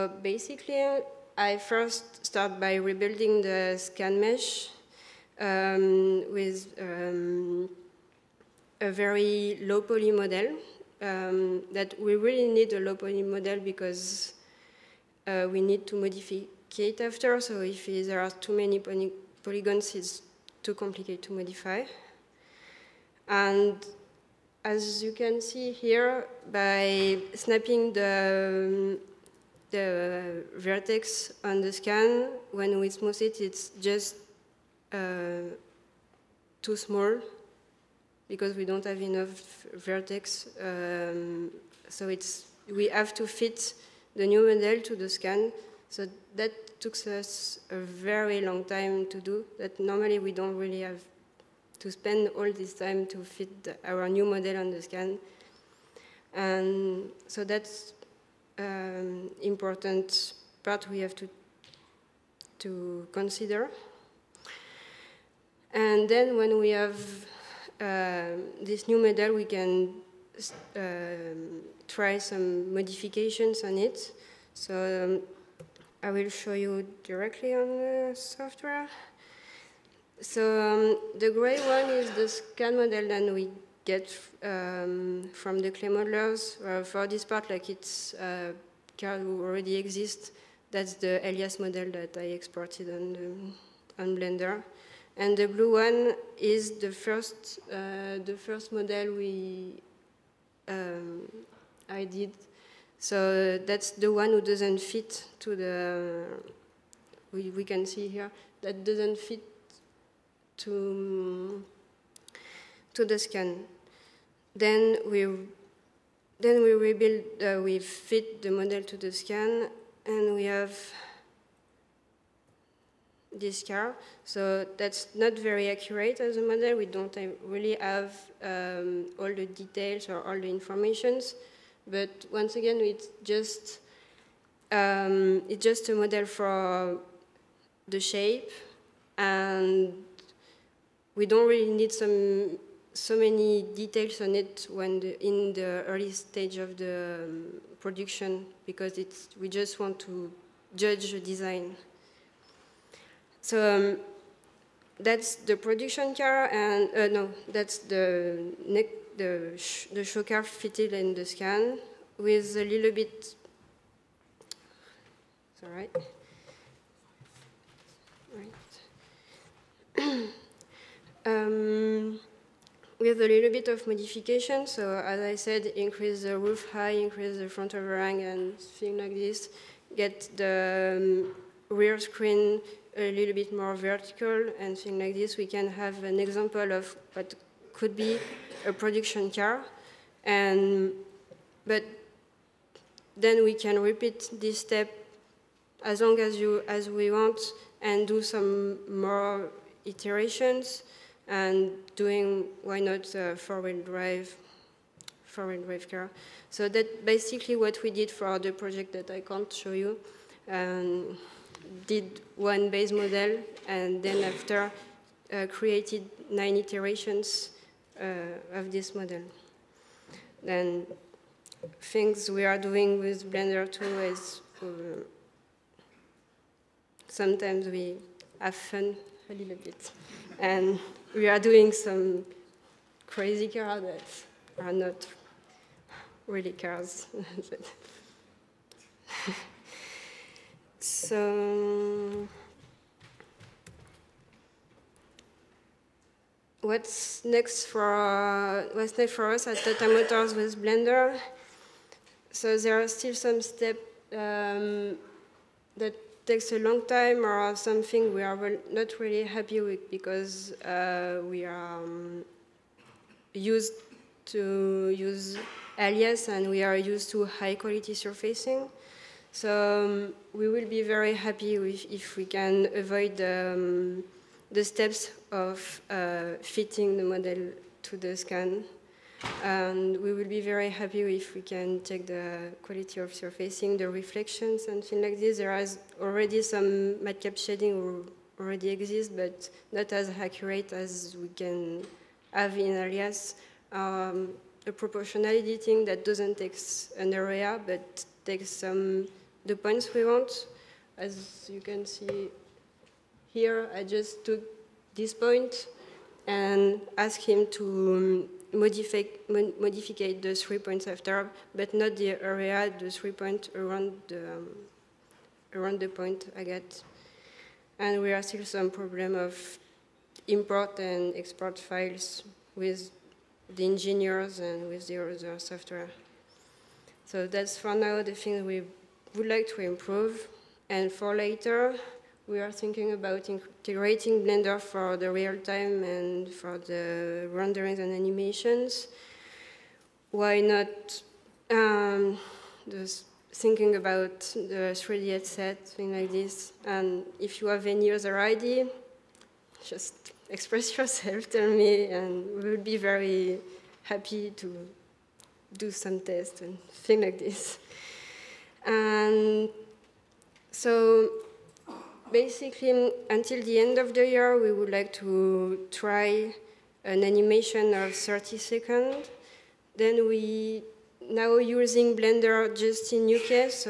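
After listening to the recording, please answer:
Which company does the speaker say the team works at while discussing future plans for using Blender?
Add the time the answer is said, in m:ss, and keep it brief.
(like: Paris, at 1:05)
Tata Motors, at 4:09.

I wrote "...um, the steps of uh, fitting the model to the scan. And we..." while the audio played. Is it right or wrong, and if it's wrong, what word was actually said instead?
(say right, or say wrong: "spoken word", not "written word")
right.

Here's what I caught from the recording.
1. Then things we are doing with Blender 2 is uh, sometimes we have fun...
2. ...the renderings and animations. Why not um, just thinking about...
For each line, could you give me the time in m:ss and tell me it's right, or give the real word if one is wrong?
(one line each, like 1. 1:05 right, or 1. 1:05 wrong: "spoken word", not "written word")
1. 3:40 right
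2. 5:36 right.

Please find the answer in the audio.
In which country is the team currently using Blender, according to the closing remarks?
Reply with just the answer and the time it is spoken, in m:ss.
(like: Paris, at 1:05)
UK, at 6:13.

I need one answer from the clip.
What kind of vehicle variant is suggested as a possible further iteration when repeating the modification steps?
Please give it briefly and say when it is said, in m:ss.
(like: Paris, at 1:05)
four-wheel drive car, at 3:25.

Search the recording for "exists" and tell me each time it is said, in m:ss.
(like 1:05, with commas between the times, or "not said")
1:29, 4:48.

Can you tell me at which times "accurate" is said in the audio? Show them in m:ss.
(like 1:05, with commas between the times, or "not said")
2:05, 4:50.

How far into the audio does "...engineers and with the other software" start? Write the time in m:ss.
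5:23.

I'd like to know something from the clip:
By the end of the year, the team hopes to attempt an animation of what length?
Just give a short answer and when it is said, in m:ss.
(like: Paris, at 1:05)
30 seconds, at 6:07.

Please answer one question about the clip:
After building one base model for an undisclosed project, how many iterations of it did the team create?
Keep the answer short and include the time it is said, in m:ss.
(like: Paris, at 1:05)
9, at 3:36.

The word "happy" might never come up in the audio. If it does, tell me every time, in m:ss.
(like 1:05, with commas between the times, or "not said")
4:19, 4:31, 4:40, 5:53.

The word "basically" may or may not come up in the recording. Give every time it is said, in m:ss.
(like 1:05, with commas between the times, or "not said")
0:00, 3:27, 6:02.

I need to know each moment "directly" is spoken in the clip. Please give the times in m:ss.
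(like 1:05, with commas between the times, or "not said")
1:17.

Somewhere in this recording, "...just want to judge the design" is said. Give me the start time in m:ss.
2:29.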